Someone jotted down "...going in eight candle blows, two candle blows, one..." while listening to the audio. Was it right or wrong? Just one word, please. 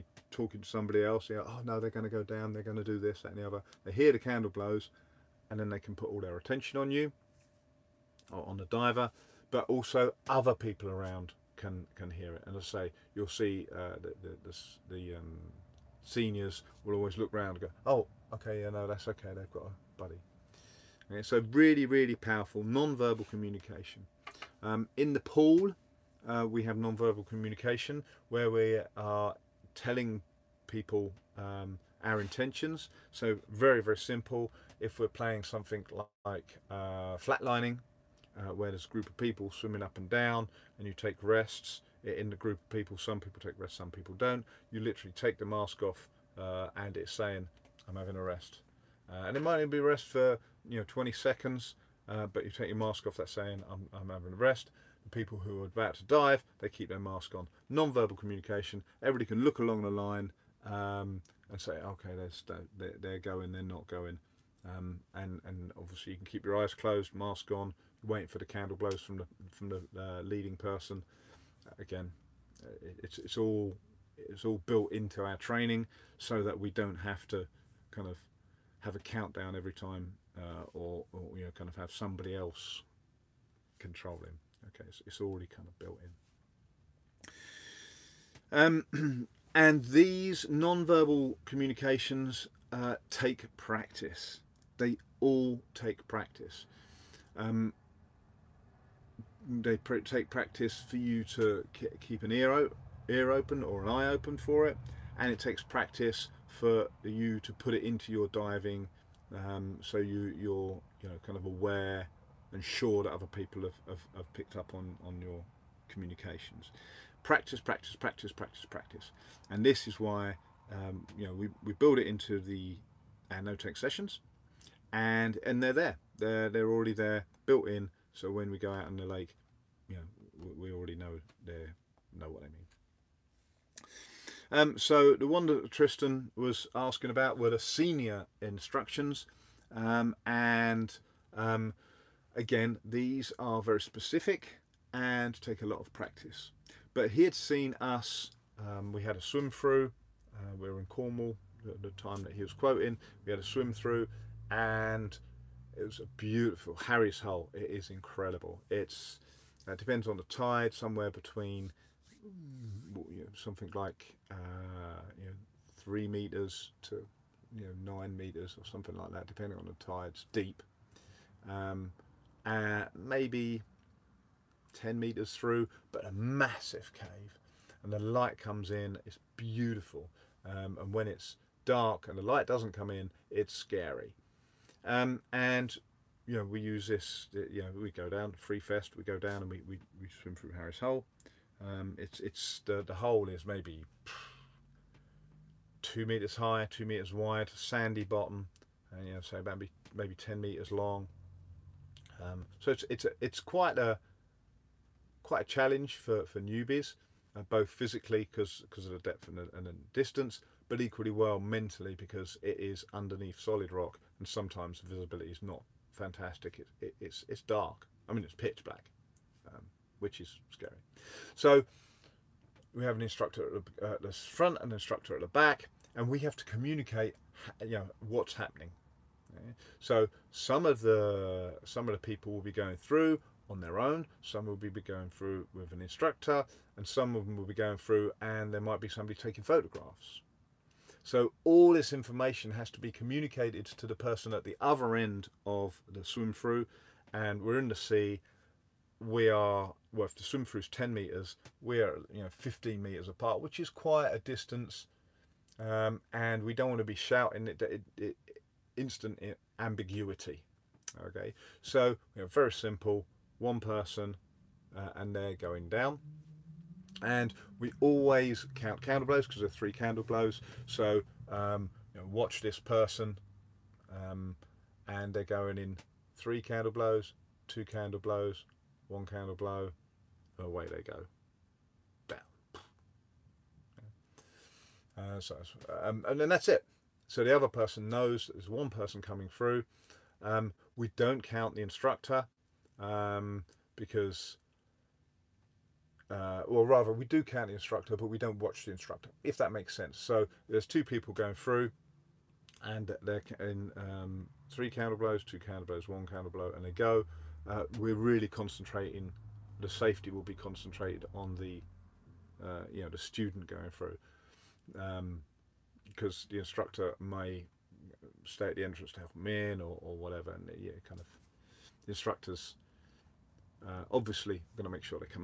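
wrong.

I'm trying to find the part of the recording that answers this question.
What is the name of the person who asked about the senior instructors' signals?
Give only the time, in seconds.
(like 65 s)
135 s.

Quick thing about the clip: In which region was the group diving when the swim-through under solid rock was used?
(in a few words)
Cornwall.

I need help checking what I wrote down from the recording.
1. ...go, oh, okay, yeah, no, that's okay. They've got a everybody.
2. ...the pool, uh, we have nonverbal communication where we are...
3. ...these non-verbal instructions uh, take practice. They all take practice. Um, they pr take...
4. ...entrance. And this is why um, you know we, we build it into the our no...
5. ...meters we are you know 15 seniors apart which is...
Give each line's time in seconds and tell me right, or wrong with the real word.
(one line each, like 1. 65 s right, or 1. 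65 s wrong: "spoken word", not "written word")
1. 17 s wrong: "buddy", not "everybody"
2. 25 s right
3. 89 s wrong: "communications", not "instructions"
4. 118 s wrong: "practice", not "entrance"
5. 250 s wrong: "meters", not "seniors".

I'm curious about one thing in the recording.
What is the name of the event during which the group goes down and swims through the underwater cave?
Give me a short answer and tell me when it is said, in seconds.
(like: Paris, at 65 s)
Free Fest, at 188 s.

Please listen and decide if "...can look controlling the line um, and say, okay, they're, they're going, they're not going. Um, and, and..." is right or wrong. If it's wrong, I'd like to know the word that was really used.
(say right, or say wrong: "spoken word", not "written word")
wrong: "along", not "controlling".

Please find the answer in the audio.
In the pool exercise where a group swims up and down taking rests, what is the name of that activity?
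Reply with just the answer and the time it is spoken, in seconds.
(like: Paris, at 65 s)
flatlining, at 37 s.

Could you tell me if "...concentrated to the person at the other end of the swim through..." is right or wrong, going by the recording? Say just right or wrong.
wrong.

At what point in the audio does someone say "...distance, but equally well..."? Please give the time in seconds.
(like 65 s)
209 s.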